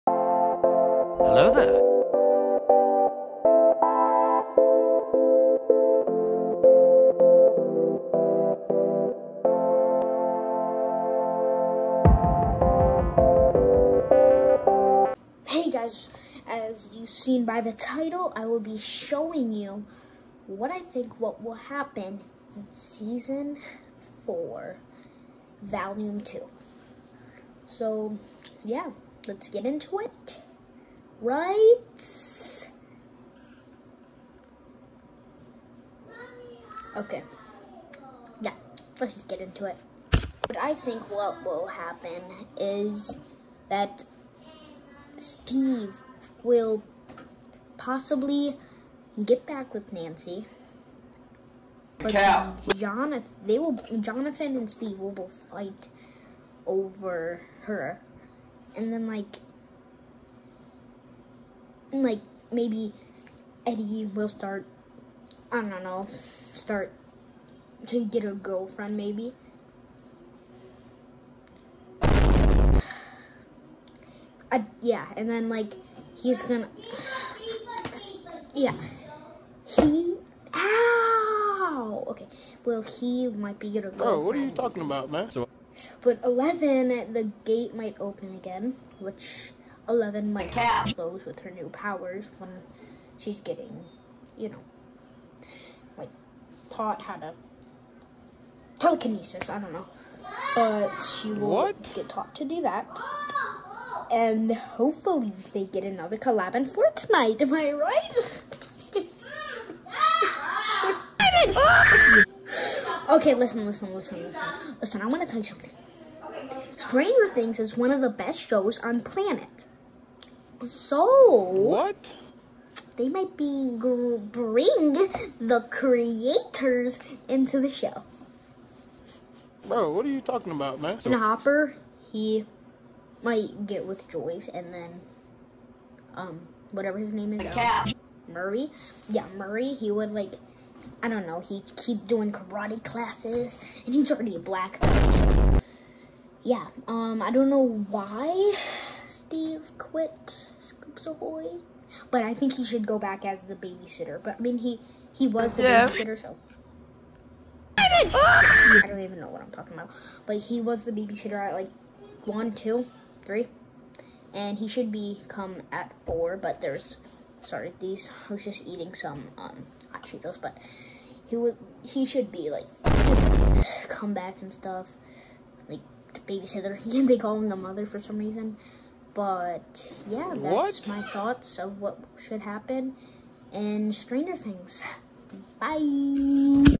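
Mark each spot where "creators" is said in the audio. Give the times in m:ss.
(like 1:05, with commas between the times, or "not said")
2:05.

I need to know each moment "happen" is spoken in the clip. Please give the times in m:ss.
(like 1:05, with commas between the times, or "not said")
0:21, 0:41, 3:02.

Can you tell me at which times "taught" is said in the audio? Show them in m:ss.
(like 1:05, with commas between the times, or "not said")
1:36, 1:42.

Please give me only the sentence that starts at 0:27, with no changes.
So, yeah, let's get into it right?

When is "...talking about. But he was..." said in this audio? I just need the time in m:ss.
2:39.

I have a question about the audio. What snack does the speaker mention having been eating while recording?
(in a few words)
Hot Cheetos.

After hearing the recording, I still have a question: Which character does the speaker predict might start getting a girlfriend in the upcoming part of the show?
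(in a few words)
Eddie.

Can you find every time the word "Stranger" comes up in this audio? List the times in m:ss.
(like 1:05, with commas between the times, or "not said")
1:56, 3:03.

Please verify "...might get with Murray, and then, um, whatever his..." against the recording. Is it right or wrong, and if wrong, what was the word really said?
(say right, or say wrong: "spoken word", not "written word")
wrong: "Joyce", not "Murray".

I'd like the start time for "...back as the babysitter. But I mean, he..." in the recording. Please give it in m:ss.
2:32.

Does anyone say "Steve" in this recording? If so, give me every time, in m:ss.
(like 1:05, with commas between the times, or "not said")
0:45, 0:54, 2:29.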